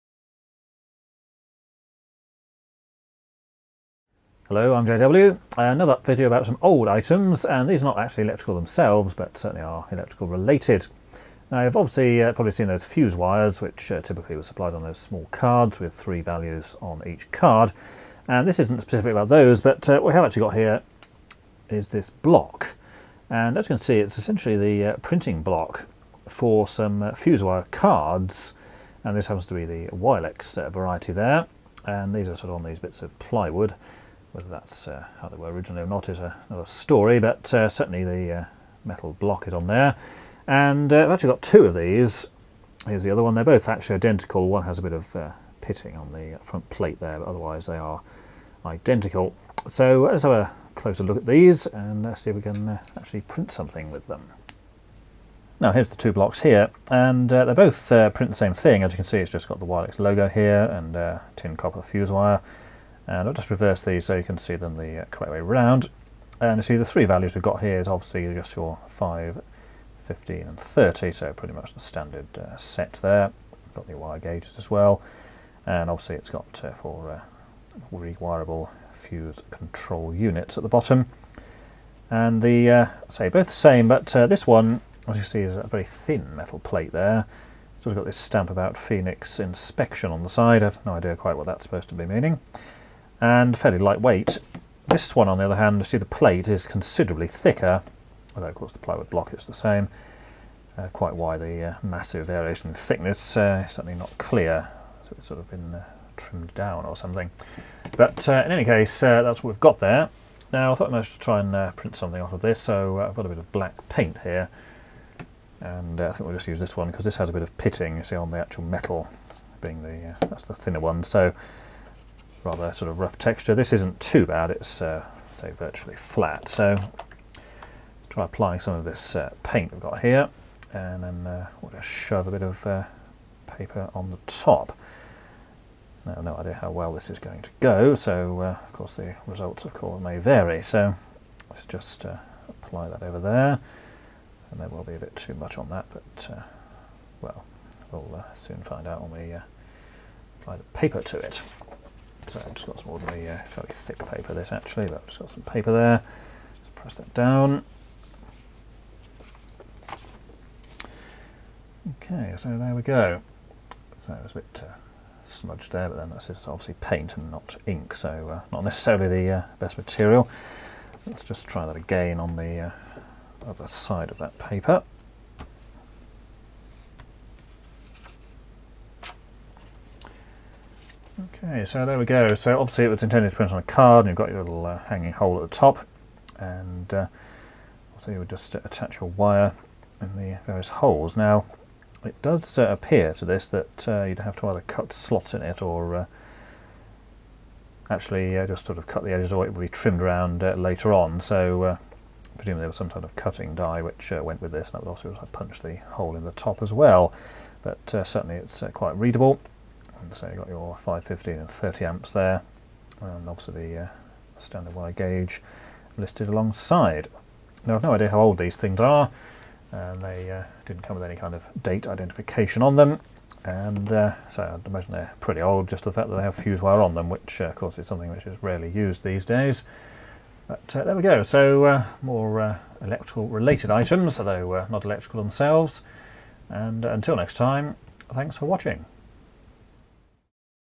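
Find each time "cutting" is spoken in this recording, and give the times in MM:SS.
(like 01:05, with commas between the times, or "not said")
03:23.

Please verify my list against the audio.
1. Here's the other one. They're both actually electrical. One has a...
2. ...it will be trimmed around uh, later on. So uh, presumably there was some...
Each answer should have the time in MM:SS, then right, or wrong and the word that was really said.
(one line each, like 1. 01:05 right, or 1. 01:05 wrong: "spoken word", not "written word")
1. 00:42 wrong: "identical", not "electrical"
2. 03:19 right.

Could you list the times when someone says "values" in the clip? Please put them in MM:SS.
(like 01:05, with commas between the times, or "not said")
00:16, 01:07.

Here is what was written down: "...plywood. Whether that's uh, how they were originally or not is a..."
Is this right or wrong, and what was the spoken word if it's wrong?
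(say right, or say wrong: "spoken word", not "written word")
right.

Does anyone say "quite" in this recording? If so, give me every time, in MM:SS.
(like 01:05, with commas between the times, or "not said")
01:31, 01:40, 03:28.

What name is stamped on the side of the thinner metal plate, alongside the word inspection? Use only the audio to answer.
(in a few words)
Phoenix.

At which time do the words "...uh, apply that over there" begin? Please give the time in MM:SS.
02:22.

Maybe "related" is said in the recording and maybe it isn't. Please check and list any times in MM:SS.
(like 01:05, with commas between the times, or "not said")
00:10, 03:53.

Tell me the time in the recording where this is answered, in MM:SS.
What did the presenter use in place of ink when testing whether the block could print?
01:53.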